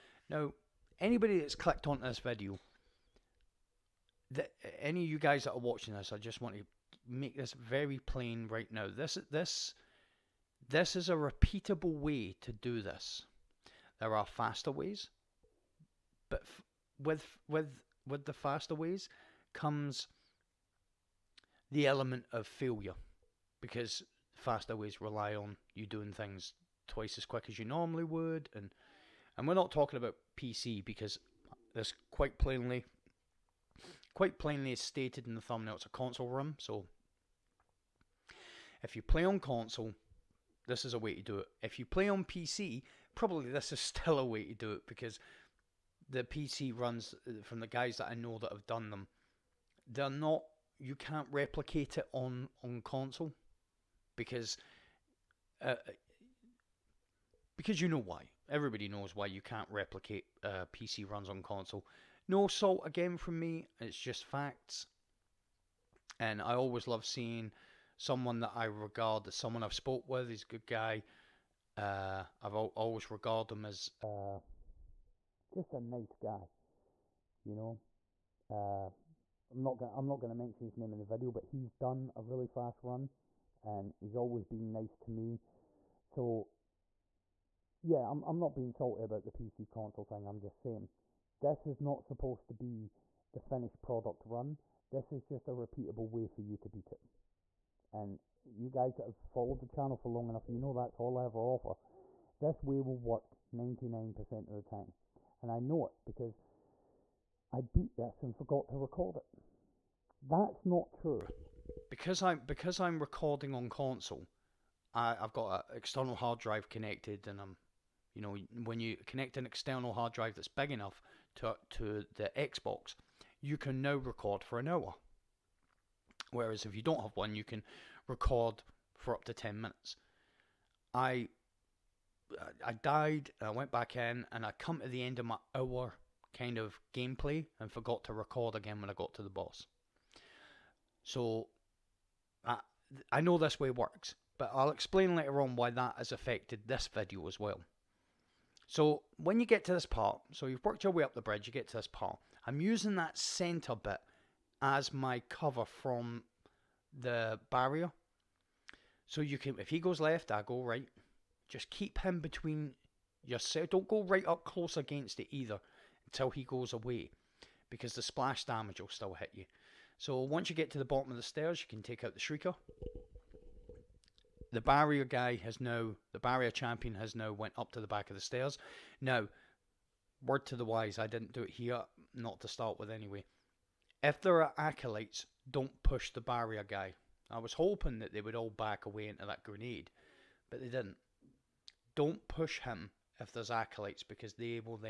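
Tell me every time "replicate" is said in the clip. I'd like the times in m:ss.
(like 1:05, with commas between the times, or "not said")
0:51, 0:59.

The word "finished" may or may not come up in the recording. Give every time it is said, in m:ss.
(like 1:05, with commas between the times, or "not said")
1:33.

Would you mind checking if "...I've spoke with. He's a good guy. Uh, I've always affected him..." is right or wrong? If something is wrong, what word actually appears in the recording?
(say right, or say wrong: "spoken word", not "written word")
wrong: "regarded", not "affected".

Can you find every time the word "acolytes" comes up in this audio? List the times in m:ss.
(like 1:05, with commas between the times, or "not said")
3:04, 3:13.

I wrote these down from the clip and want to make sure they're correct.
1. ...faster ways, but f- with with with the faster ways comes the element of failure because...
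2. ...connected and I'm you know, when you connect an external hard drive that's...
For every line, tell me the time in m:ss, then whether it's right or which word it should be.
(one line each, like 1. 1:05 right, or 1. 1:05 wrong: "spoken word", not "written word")
1. 0:14 right
2. 1:56 right.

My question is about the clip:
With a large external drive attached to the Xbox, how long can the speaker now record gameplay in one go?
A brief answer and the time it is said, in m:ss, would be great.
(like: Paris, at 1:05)
an hour, at 2:04.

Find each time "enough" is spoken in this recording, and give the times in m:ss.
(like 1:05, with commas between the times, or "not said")
1:40, 2:00.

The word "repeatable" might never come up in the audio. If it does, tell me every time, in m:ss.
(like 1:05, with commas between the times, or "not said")
0:11, 1:35.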